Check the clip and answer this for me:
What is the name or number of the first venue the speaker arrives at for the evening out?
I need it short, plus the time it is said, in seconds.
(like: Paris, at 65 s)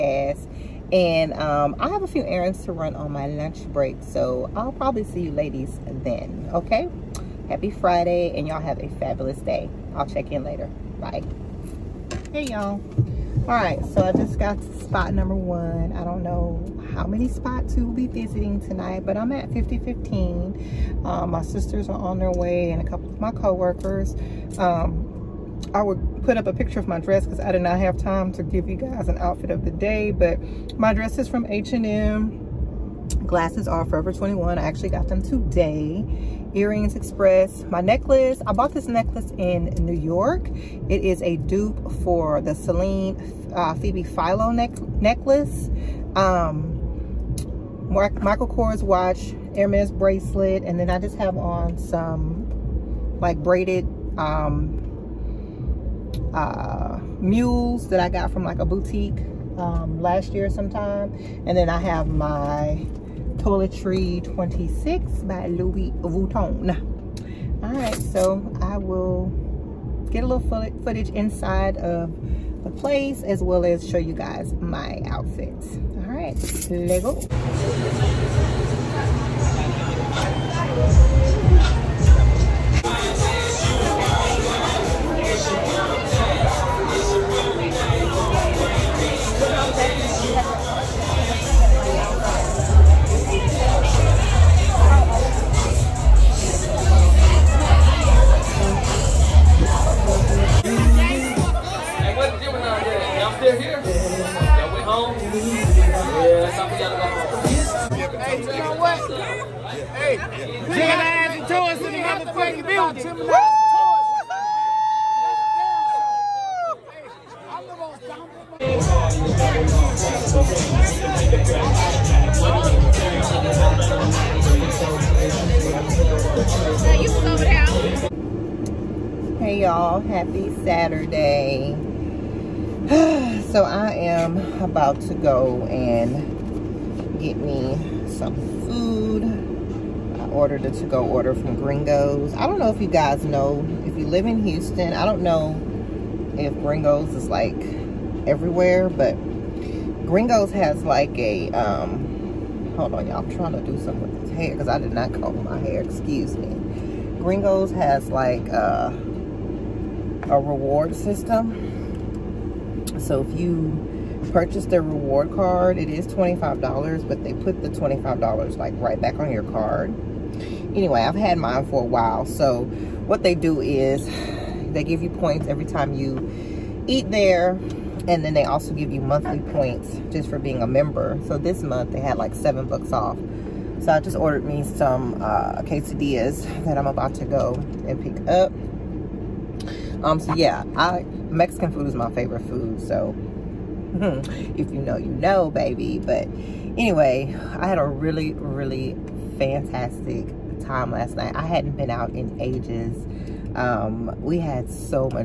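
5015, at 19 s.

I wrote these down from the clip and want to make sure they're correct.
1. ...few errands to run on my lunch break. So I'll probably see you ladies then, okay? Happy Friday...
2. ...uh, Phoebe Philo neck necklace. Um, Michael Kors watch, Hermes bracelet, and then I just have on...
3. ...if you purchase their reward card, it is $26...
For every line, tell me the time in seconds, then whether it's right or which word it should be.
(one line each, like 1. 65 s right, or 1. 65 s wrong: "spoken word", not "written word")
1. 2 s right
2. 43 s right
3. 163 s wrong: "25", not "26".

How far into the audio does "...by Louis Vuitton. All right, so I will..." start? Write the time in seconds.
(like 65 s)
65 s.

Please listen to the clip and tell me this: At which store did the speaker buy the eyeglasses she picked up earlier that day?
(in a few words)
Forever 21.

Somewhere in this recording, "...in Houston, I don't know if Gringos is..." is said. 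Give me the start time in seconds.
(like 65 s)
144 s.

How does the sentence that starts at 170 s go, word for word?
Anyway, I've had mine for a while.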